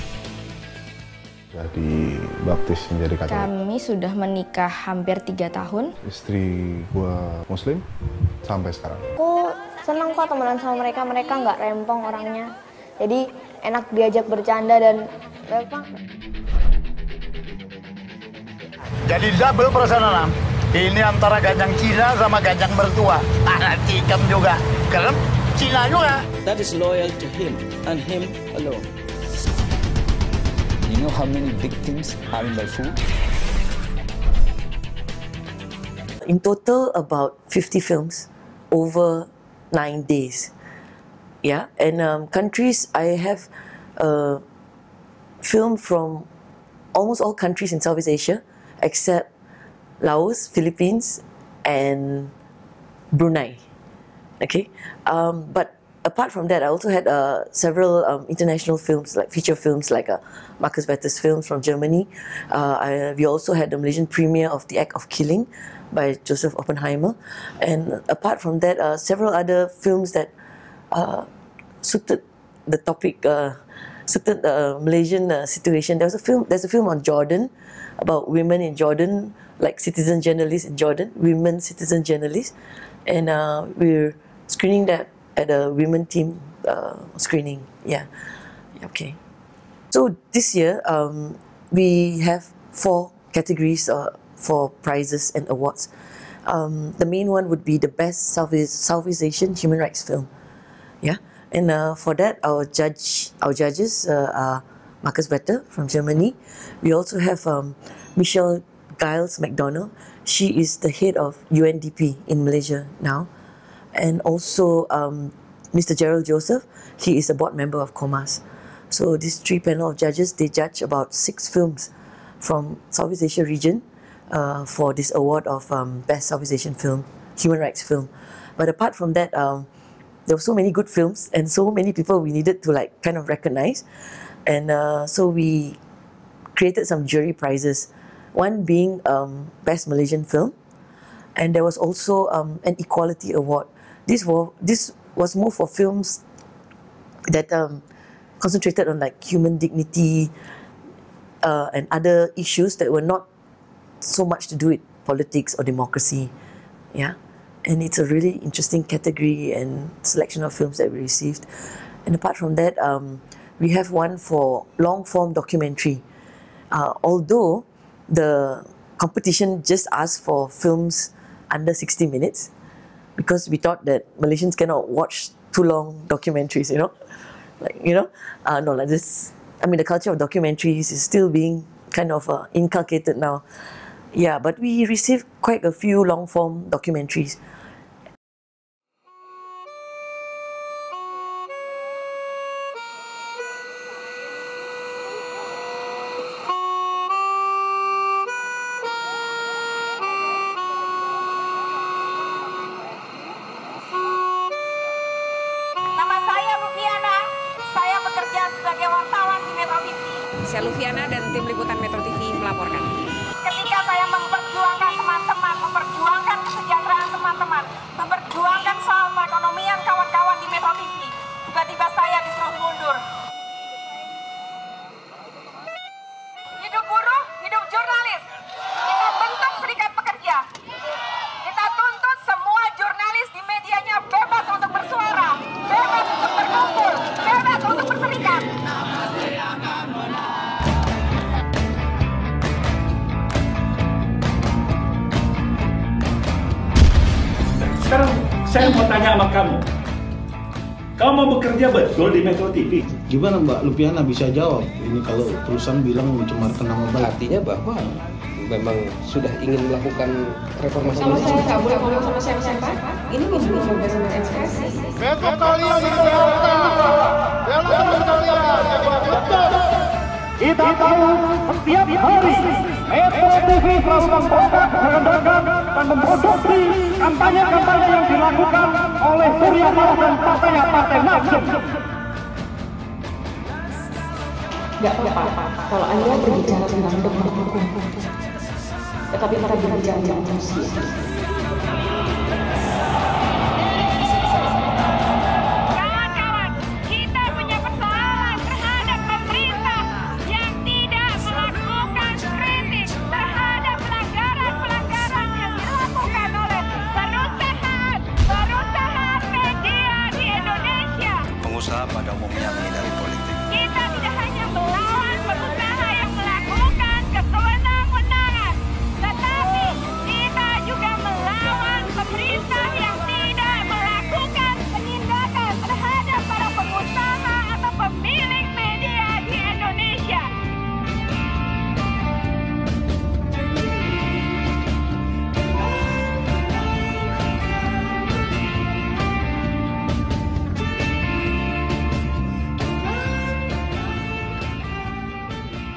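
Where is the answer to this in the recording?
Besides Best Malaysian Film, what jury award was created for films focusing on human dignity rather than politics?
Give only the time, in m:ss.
2:22.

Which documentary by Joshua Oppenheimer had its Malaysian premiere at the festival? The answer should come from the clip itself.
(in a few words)
The Act of Killing.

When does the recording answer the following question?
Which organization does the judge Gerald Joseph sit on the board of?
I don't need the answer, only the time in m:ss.
1:57.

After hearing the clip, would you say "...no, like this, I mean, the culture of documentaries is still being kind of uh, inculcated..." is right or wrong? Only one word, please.
right.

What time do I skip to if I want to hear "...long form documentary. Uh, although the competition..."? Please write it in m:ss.
2:44.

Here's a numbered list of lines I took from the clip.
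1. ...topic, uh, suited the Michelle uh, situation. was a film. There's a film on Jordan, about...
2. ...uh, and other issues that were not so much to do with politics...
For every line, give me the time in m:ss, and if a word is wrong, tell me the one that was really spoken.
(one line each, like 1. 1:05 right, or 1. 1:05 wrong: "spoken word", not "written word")
1. 1:12 wrong: "Malaysian", not "Michelle"
2. 2:31 right.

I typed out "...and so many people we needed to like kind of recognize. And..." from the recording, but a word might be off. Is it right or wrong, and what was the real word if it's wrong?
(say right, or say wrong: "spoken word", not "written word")
right.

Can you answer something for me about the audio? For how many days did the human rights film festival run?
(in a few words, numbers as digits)
9.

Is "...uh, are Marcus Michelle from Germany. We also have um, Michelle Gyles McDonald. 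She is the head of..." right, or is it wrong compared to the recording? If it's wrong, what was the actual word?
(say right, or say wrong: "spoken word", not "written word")
wrong: "Vetter", not "Michelle".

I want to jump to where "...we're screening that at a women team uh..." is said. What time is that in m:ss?
1:23.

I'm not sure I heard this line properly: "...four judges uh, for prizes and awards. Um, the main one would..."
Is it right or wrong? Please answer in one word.
wrong.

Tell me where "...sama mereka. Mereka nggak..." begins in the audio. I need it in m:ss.
0:10.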